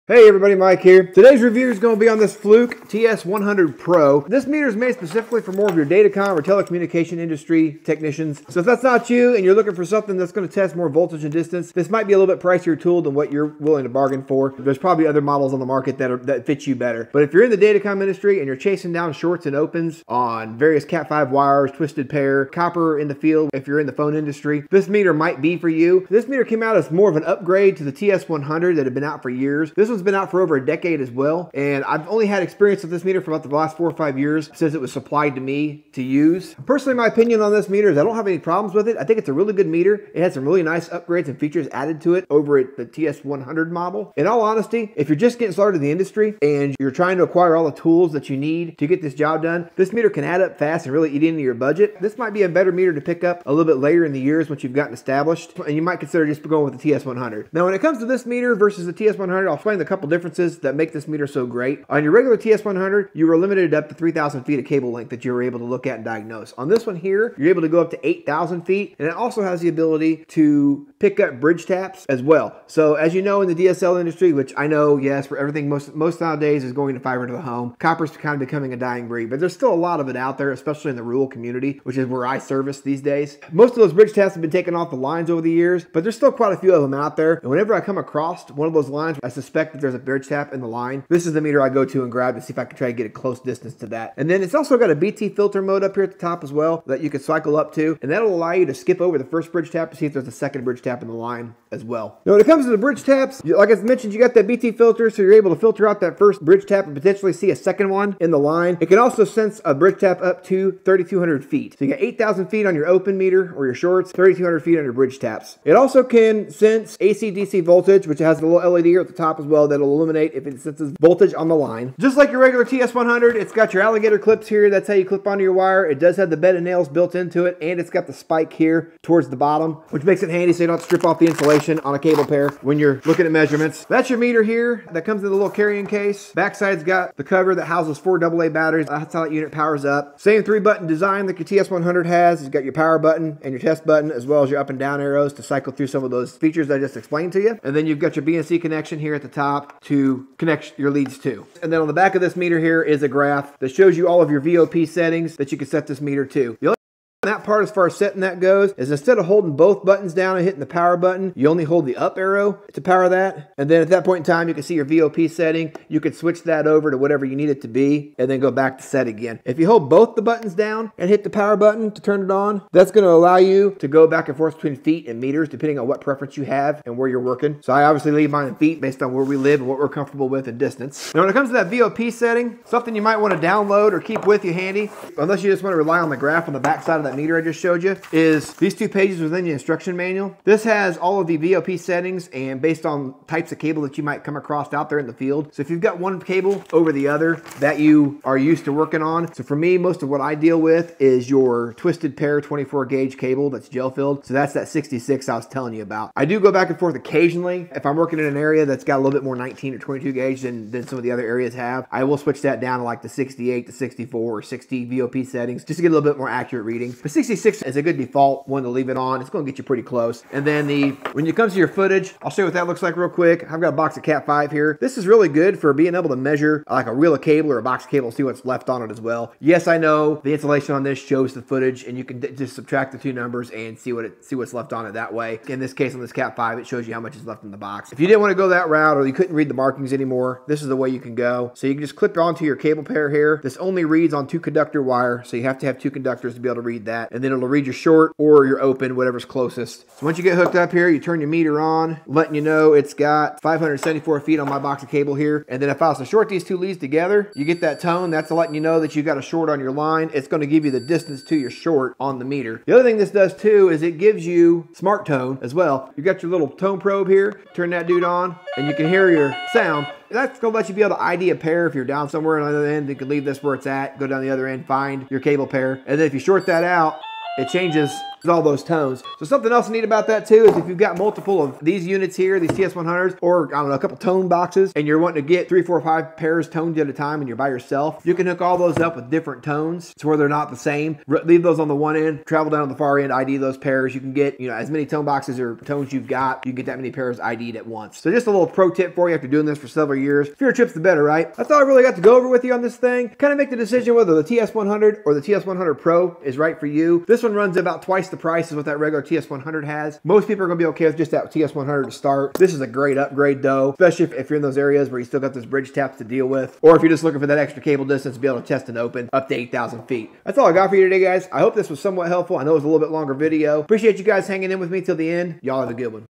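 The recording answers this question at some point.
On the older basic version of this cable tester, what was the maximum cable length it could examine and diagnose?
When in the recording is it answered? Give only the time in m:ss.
1:03.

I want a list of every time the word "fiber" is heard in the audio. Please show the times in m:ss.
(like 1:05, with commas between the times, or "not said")
1:17.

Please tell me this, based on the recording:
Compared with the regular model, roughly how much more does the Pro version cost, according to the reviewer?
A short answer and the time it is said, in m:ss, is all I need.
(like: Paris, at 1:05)
twice the price, at 5:07.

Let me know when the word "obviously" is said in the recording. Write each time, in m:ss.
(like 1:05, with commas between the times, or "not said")
2:57.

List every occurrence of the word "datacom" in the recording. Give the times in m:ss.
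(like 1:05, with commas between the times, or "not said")
0:05, 0:17.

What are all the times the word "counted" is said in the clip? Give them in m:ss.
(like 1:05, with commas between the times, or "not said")
not said.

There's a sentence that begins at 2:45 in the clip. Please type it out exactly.
You can switch that over to whatever you need it to be and then go back to set again.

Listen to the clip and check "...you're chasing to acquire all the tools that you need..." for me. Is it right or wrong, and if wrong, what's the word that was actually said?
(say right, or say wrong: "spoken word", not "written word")
wrong: "trying", not "chasing".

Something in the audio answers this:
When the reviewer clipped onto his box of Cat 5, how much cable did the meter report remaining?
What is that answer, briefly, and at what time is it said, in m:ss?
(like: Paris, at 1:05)
574 feet, at 4:13.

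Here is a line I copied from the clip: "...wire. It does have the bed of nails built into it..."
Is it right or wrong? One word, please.
right.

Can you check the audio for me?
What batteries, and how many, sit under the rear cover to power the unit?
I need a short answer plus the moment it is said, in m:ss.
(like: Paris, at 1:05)
4 AA, at 2:17.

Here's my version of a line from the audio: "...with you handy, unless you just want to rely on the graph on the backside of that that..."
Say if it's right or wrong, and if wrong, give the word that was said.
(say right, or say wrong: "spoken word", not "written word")
right.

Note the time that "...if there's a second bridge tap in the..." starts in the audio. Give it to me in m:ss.
1:40.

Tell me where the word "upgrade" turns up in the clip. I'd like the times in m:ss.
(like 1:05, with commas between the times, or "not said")
0:27, 0:40, 5:12.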